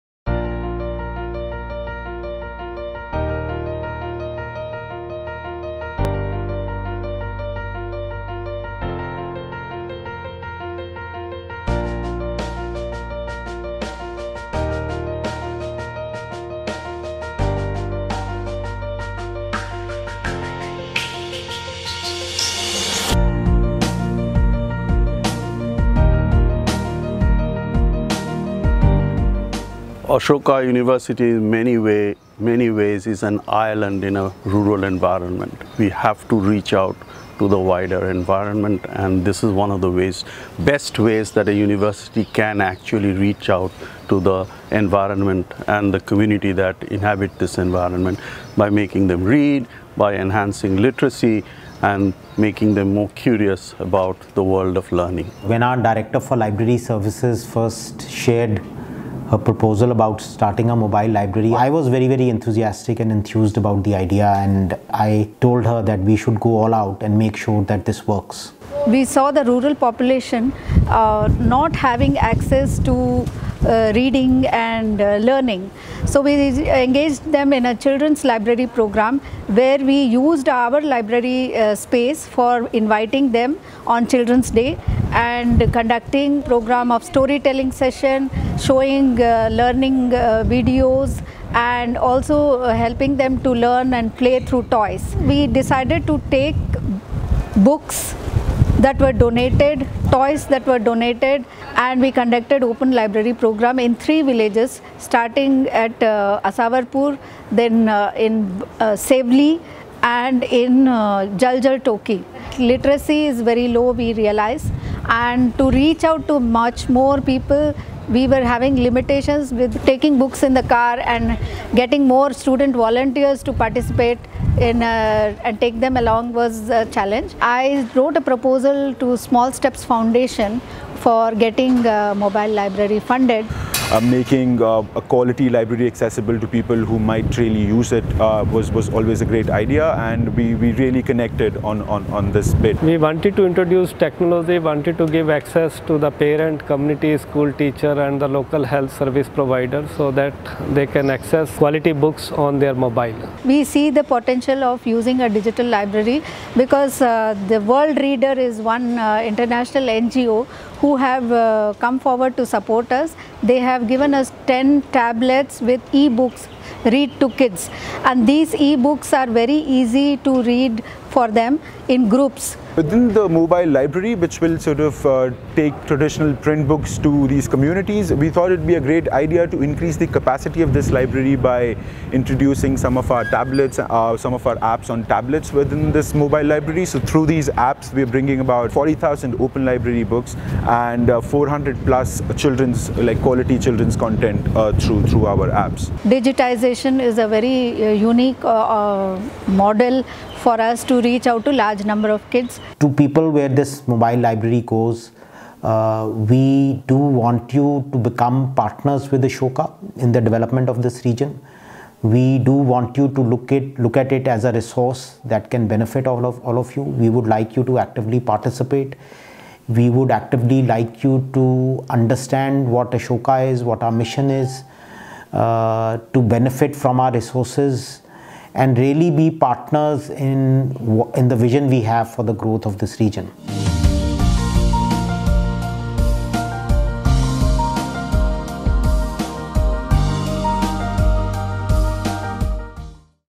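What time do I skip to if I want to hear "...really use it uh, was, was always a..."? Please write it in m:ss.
2:17.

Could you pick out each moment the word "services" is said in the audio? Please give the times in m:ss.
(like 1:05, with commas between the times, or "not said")
0:56, 2:28.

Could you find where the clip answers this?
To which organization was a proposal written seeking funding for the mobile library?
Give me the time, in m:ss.
2:09.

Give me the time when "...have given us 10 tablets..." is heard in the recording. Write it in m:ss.
2:43.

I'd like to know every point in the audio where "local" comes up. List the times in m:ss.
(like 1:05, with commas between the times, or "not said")
2:28.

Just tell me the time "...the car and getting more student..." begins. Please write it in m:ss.
2:00.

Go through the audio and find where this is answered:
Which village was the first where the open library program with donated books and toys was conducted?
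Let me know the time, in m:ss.
1:46.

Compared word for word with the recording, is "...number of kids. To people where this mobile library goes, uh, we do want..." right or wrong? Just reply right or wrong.
right.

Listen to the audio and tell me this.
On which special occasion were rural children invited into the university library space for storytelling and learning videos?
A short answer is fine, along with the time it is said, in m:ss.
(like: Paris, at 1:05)
Children's Day, at 1:24.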